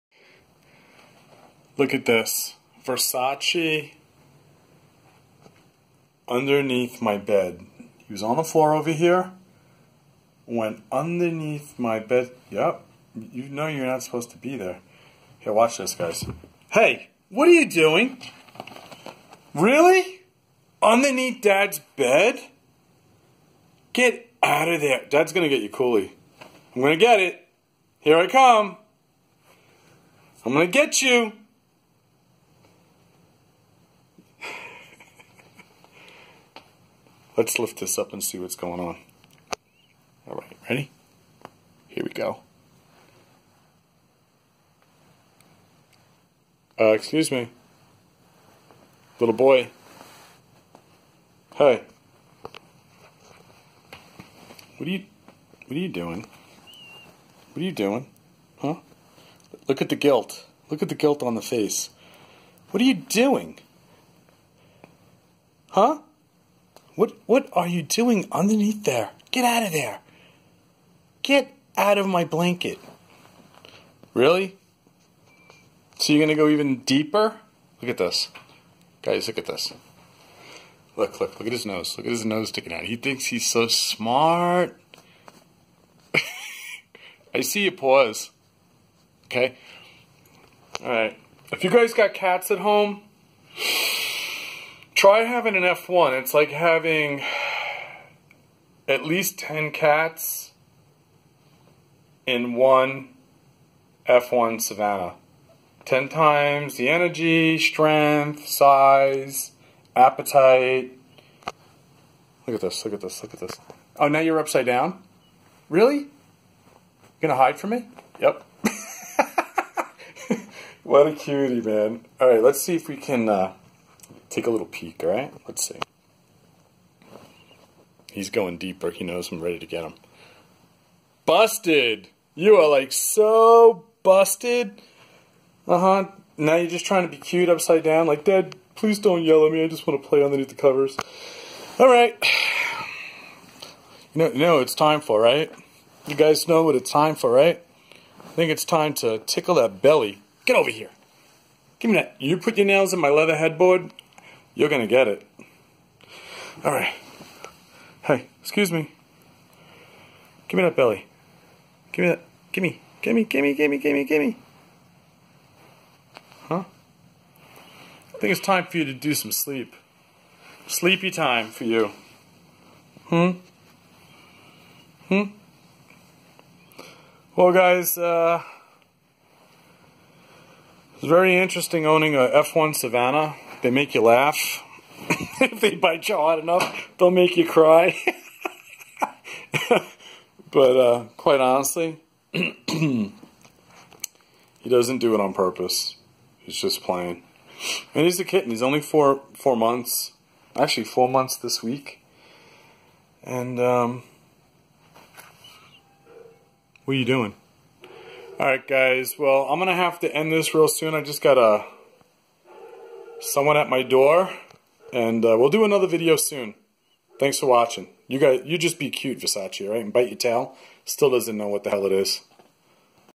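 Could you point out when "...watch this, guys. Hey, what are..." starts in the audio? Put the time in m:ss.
0:15.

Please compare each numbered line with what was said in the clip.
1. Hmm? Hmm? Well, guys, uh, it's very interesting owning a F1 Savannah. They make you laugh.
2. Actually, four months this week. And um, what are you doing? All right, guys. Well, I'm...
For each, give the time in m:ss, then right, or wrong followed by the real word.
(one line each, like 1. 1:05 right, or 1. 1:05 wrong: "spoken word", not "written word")
1. 2:53 right
2. 3:20 right.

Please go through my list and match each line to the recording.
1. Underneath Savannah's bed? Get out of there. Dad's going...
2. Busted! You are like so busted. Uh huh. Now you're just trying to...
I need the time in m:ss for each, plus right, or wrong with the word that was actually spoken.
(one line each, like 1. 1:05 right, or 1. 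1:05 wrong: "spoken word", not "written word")
1. 0:20 wrong: "Dad", not "Savannah"
2. 2:11 right.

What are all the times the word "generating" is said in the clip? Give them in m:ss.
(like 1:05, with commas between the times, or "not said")
not said.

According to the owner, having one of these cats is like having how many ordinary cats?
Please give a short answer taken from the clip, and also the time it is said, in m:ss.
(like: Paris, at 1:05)
10, at 1:38.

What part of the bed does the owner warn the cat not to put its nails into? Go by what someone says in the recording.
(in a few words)
leather headboard.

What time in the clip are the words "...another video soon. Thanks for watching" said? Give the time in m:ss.
3:35.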